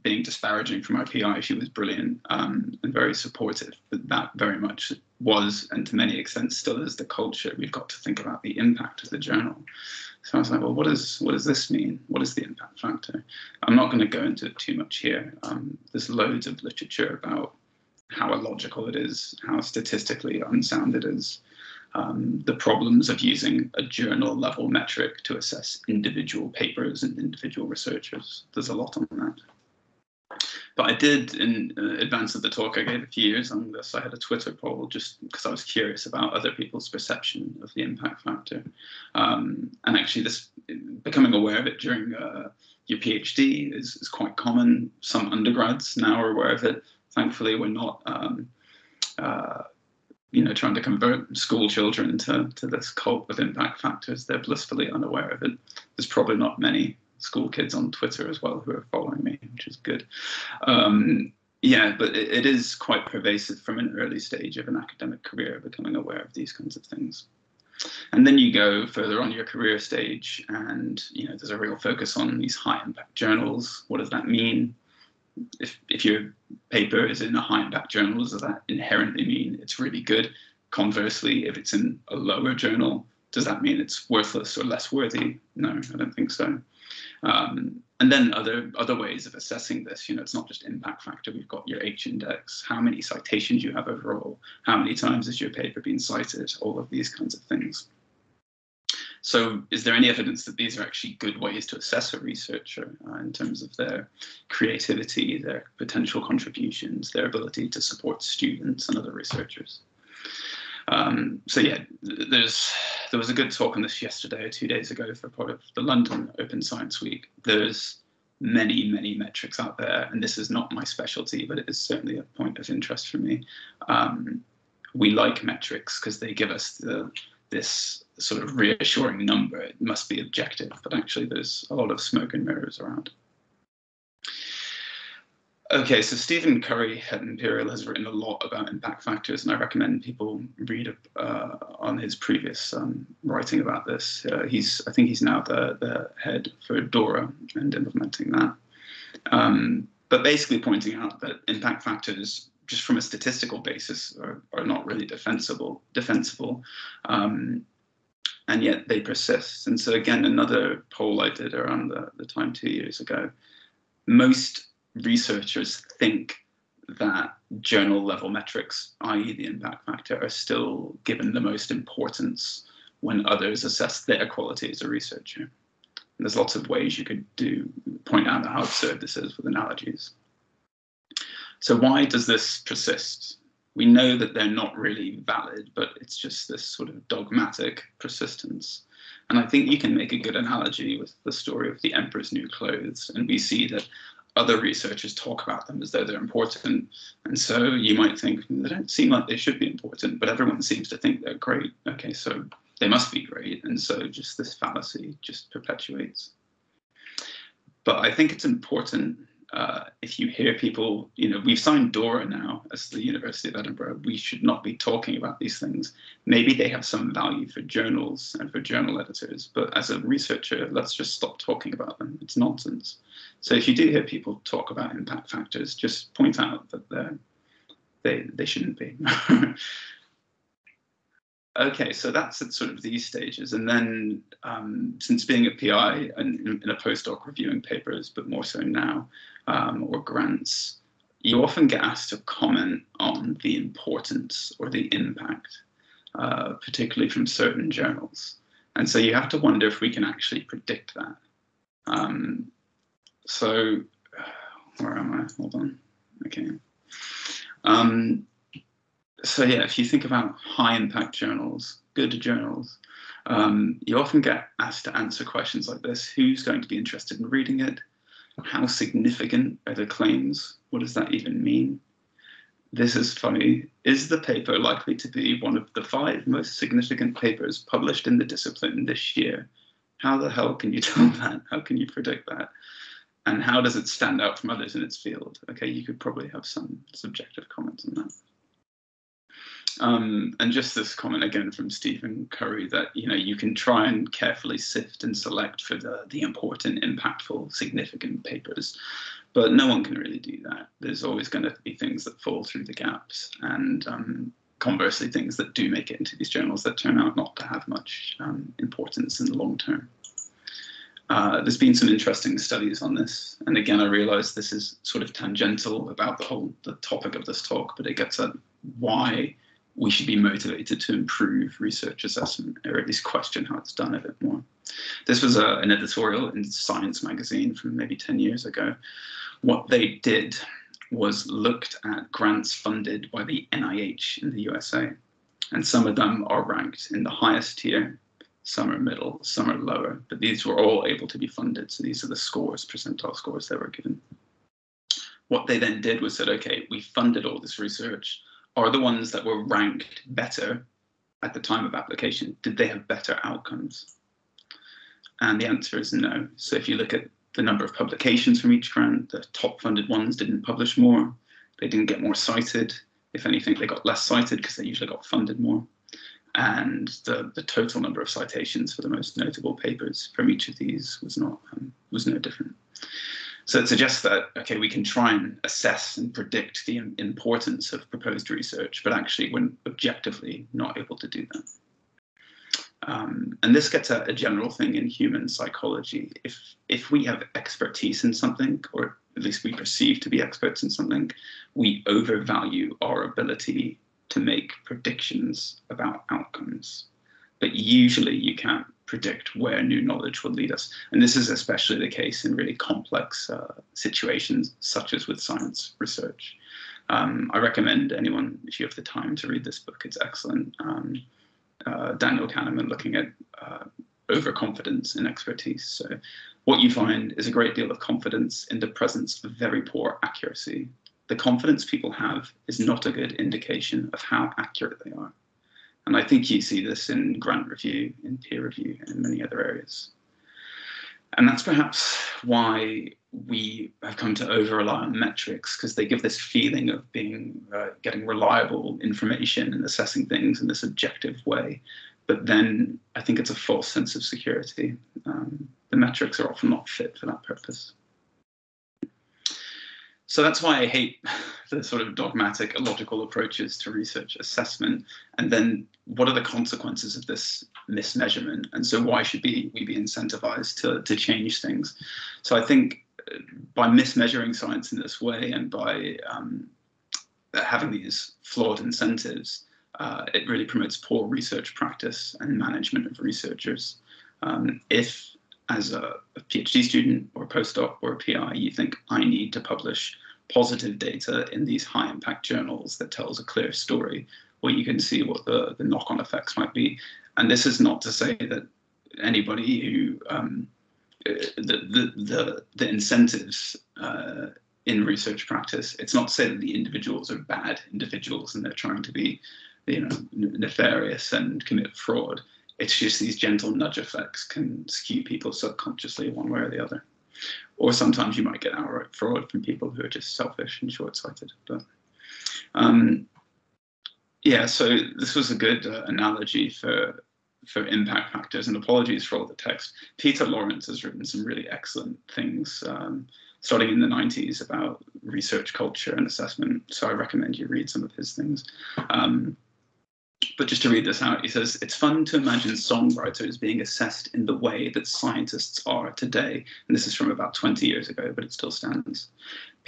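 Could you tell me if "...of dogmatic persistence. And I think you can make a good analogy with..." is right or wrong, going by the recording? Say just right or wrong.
right.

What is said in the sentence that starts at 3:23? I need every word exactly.
And so just this fallacy just perpetuates.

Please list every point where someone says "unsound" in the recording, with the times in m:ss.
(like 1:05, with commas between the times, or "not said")
0:20.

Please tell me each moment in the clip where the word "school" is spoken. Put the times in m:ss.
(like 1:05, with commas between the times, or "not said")
0:51, 0:57.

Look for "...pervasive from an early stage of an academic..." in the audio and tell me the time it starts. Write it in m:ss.
1:03.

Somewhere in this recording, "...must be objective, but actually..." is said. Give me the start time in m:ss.
2:09.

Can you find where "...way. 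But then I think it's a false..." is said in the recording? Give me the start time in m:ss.
7:21.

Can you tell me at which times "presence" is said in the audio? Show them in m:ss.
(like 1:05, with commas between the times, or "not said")
6:58.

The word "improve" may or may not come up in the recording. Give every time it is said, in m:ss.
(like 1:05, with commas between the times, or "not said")
5:20.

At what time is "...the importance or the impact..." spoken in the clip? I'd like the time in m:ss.
4:03.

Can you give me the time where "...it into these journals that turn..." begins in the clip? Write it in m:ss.
5:05.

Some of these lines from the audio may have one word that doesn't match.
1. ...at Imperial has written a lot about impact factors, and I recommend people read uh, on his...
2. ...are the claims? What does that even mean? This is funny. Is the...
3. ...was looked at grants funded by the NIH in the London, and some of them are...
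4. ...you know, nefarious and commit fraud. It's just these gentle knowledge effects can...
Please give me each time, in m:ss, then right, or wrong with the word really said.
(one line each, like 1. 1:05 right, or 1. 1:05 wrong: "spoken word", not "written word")
1. 2:17 right
2. 4:29 right
3. 5:30 wrong: "USA", not "London"
4. 8:19 wrong: "nudge", not "knowledge".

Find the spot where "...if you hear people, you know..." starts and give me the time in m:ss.
3:30.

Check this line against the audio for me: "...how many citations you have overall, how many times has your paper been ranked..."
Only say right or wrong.
wrong.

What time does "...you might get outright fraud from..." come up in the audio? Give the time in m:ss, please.
8:28.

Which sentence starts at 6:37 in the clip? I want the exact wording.
But usually you can't predict where new knowledge will lead us.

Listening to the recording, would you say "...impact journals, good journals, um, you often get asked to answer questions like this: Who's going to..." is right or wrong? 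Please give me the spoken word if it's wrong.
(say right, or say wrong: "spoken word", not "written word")
right.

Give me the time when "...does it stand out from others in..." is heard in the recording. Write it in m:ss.
4:43.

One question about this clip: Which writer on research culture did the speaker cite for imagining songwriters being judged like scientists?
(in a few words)
Peter Lawrence.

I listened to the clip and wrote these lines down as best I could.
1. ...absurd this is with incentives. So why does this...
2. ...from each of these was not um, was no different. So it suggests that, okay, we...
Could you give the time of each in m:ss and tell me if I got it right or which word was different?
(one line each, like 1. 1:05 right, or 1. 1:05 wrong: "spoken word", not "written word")
1. 2:58 wrong: "analogies", not "incentives"
2. 6:10 right.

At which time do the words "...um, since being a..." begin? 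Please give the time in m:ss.
3:54.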